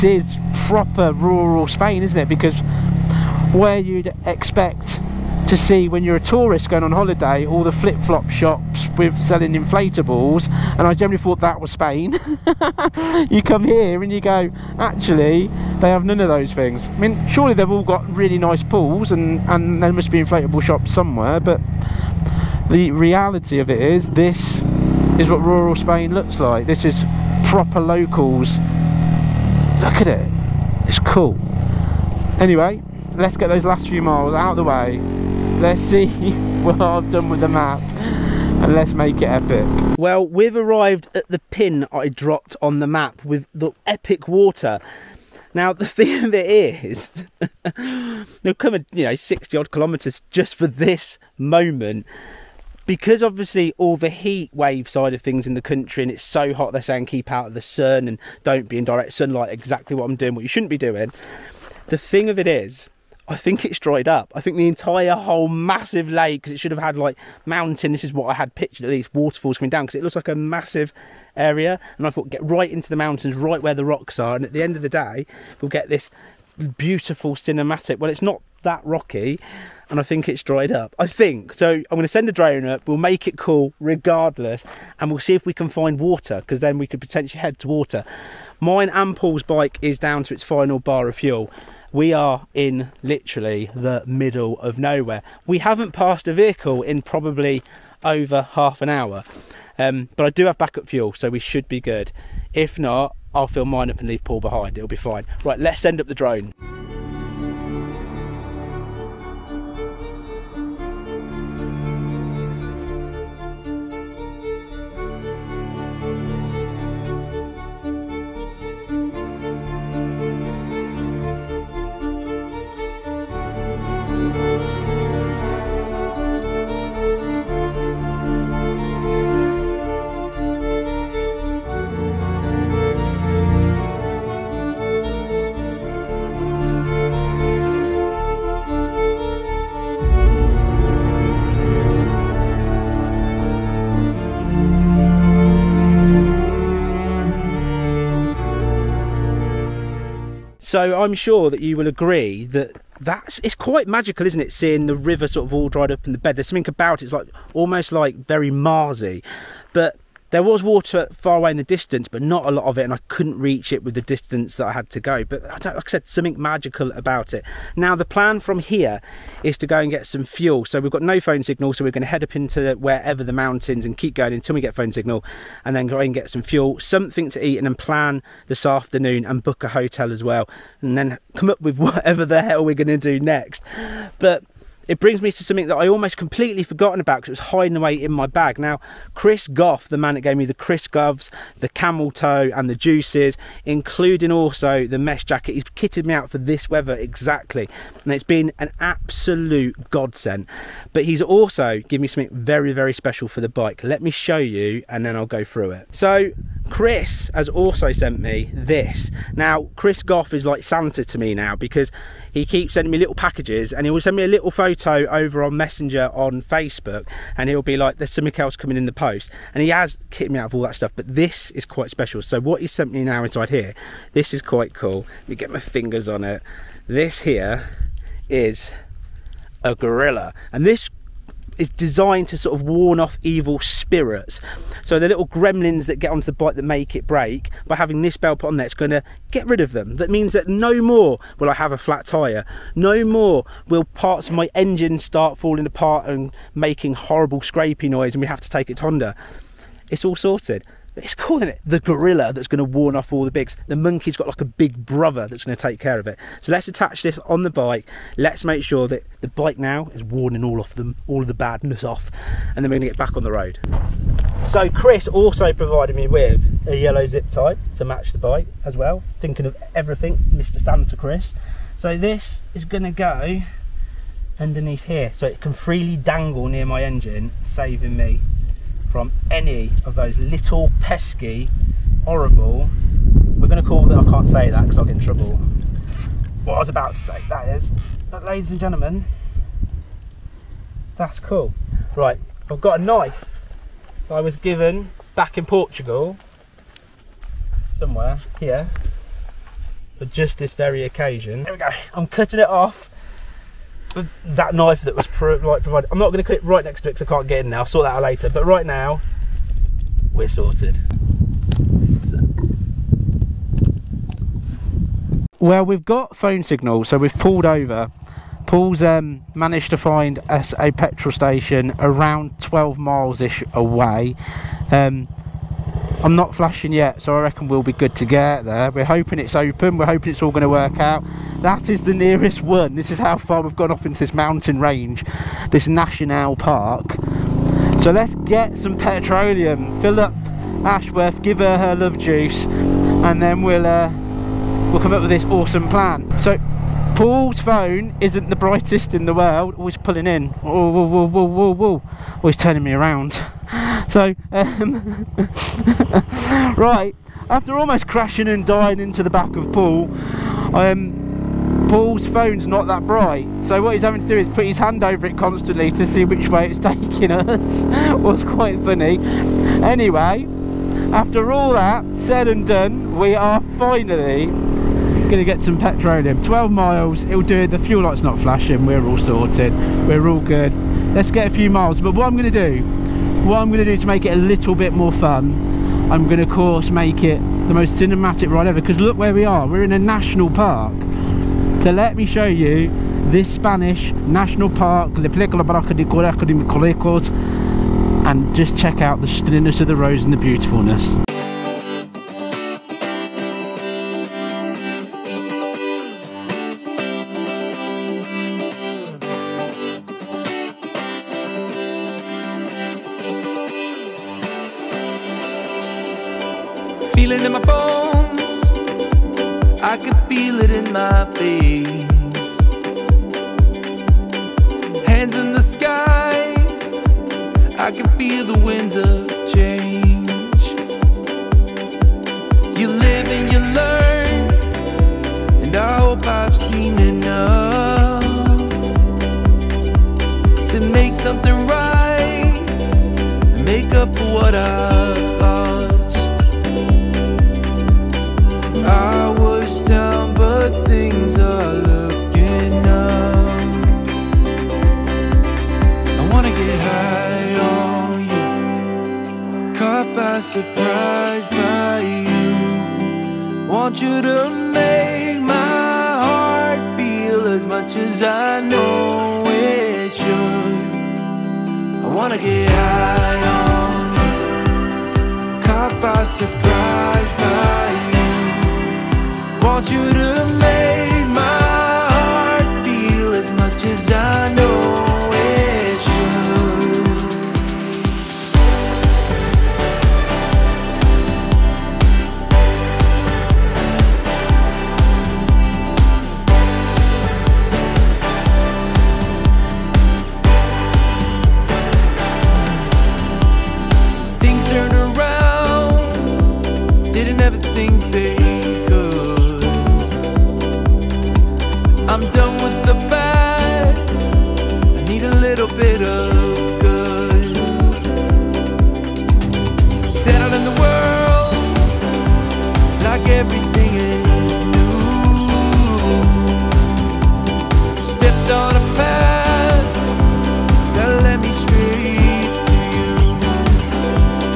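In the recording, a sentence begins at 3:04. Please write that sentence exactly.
But it brings me to something that I almost completely forgotten about because it was hiding away in my bag.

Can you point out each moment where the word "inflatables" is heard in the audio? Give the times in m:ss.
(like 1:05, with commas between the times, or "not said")
0:09, 0:20.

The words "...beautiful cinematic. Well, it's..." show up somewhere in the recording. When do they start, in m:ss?
1:16.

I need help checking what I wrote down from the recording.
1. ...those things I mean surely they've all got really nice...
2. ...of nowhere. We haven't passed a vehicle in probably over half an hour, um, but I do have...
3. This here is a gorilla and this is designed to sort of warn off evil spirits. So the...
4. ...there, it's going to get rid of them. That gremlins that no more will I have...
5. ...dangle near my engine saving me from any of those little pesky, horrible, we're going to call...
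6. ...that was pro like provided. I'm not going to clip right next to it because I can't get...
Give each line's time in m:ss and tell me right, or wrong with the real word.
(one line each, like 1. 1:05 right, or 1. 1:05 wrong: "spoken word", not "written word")
1. 0:16 right
2. 1:34 right
3. 3:46 right
4. 3:58 wrong: "means", not "gremlins"
5. 4:35 right
6. 5:04 right.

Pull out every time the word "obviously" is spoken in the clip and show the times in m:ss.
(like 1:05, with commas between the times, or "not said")
0:53.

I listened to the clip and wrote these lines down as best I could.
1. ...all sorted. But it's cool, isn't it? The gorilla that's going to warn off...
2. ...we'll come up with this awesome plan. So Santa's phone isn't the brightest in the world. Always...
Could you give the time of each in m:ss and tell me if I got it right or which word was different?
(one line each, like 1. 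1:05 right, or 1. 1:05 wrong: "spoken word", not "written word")
1. 4:10 right
2. 5:44 wrong: "Paul", not "Santa".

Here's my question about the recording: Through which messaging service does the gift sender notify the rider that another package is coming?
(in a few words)
Messenger.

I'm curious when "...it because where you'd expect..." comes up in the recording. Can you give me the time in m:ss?
0:02.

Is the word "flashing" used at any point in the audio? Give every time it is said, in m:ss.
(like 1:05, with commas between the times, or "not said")
5:26, 6:18.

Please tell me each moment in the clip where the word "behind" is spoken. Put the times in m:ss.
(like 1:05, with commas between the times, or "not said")
1:44.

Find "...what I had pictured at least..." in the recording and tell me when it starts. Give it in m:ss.
1:08.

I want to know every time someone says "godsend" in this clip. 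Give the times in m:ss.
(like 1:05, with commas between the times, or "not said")
3:19.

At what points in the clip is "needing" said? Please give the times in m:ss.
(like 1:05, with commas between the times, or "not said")
not said.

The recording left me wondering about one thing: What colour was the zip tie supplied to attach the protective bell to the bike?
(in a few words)
yellow.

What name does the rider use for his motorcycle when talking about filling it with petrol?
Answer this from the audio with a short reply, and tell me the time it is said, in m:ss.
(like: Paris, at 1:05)
Ashworth, at 5:40.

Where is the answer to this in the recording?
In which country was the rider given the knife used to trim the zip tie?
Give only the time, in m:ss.
4:55.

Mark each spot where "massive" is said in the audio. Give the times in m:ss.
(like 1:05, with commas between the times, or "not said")
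1:05, 1:10.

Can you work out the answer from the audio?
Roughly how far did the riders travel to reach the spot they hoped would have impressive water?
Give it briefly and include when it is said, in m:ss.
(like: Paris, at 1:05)
60 kilometres, at 0:49.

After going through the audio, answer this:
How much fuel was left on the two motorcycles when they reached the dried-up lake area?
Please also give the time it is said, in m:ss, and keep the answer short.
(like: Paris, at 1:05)
final bar, at 1:30.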